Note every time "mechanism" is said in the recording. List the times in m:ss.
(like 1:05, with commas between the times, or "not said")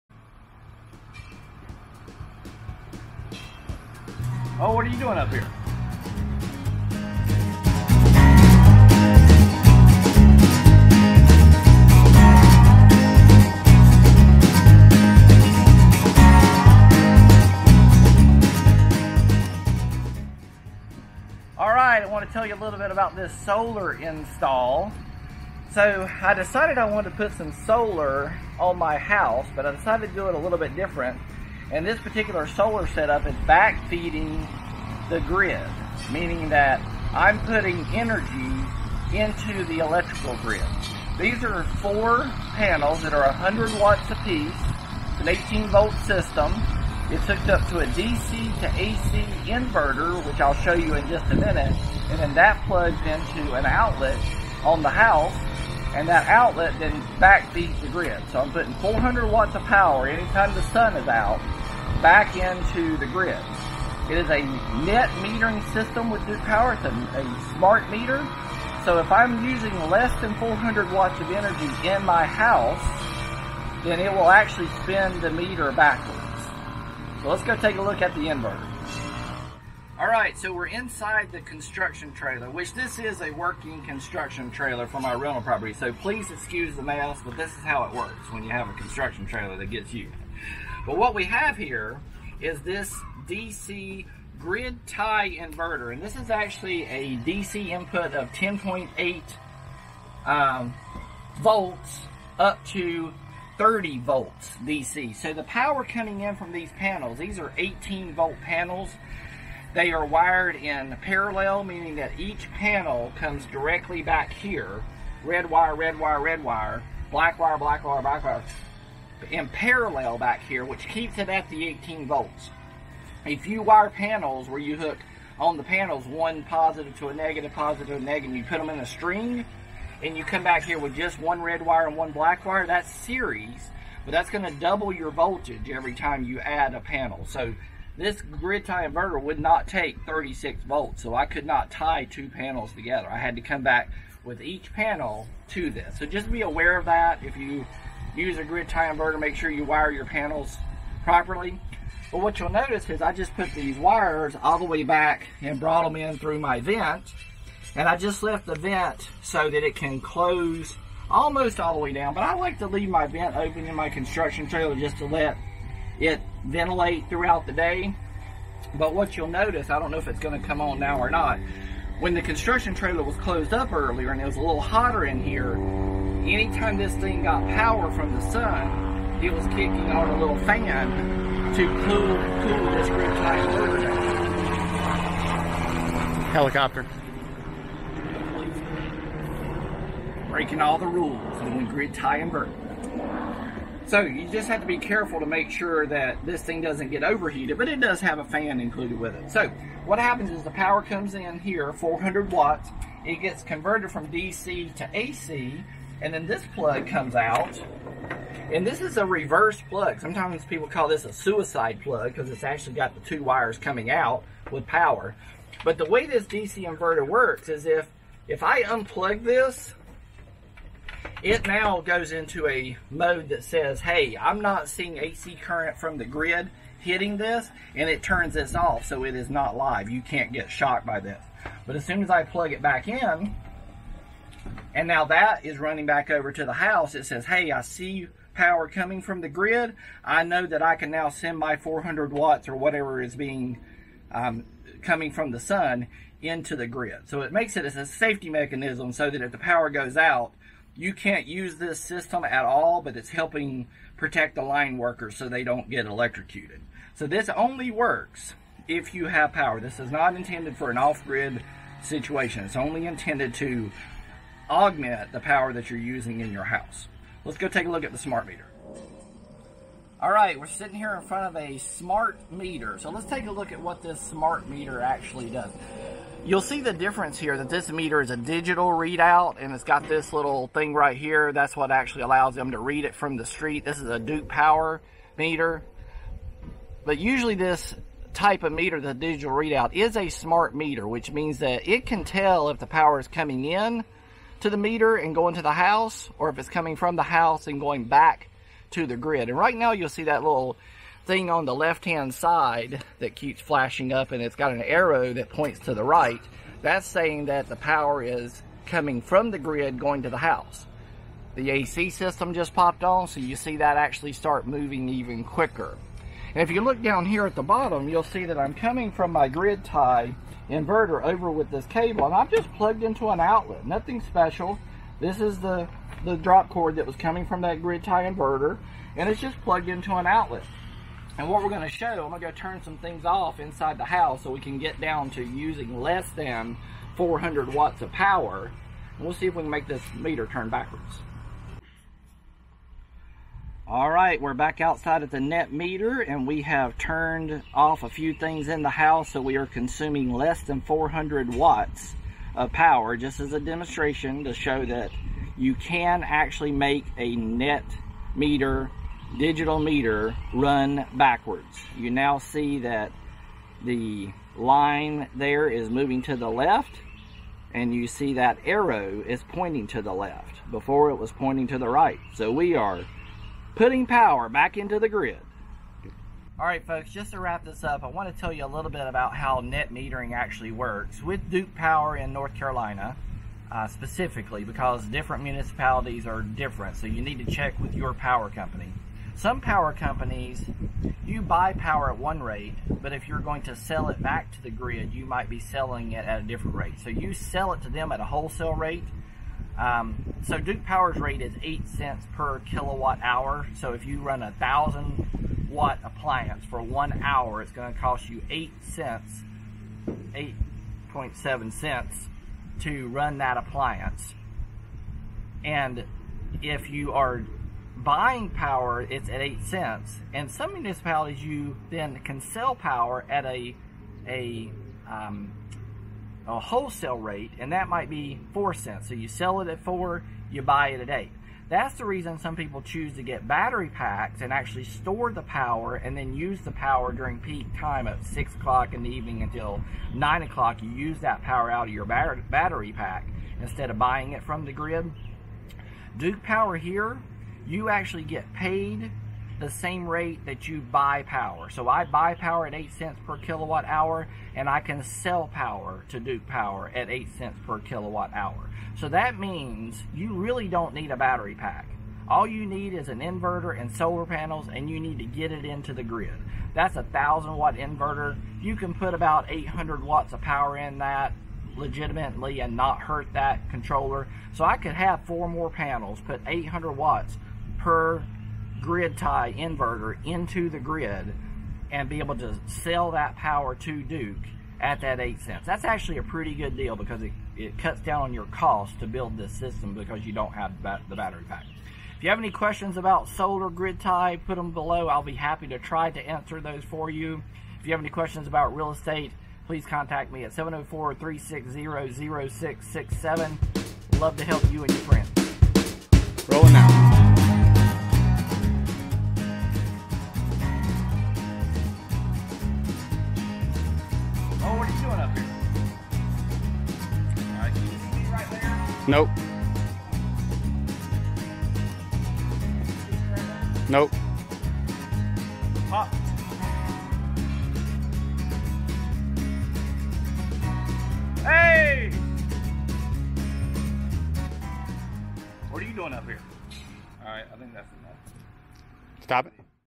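4:08.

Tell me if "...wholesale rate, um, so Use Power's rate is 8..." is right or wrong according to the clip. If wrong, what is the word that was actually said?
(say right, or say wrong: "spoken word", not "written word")
wrong: "Duke", not "Use".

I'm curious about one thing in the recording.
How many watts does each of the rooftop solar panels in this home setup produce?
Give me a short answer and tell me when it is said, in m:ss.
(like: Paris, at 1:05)
100 watts, at 0:43.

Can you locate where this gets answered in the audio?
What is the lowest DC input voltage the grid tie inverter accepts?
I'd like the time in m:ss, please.
1:38.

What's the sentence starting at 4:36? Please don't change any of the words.
You'll see the difference here that this meter is a digital readout and it's got this little thing right here.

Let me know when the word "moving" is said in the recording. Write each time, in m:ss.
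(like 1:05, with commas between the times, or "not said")
5:14, 6:05.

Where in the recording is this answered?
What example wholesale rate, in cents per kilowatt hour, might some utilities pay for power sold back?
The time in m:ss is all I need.
7:08.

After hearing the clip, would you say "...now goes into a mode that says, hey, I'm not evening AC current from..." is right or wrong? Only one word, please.
wrong.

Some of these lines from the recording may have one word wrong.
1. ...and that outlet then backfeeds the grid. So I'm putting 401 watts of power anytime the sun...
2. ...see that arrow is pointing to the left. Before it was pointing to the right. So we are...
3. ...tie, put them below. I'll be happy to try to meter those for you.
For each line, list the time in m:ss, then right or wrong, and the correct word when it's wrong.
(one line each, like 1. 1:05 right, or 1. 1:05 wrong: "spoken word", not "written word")
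1. 0:55 wrong: "400", not "401"
2. 6:07 right
3. 8:13 wrong: "answer", not "meter".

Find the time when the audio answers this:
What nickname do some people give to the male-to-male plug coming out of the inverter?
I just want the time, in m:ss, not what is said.
3:31.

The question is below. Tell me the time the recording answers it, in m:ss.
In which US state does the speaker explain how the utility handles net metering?
6:22.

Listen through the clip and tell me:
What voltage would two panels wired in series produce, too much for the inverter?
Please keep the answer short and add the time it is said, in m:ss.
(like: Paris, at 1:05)
36 volts, at 2:20.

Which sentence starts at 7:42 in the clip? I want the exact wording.
All you need is an inverter and solar panels and you need to get it into the grid.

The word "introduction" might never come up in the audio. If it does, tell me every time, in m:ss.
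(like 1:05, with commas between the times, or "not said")
not said.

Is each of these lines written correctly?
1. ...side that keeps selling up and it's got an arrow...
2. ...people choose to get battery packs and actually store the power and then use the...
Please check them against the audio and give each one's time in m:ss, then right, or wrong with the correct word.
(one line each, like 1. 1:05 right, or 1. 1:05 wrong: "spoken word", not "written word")
1. 5:02 wrong: "flashing", not "selling"
2. 7:12 right.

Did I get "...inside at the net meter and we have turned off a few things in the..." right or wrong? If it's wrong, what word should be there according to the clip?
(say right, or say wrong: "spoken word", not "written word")
wrong: "outside", not "inside".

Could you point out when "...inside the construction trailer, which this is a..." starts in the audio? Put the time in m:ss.
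1:20.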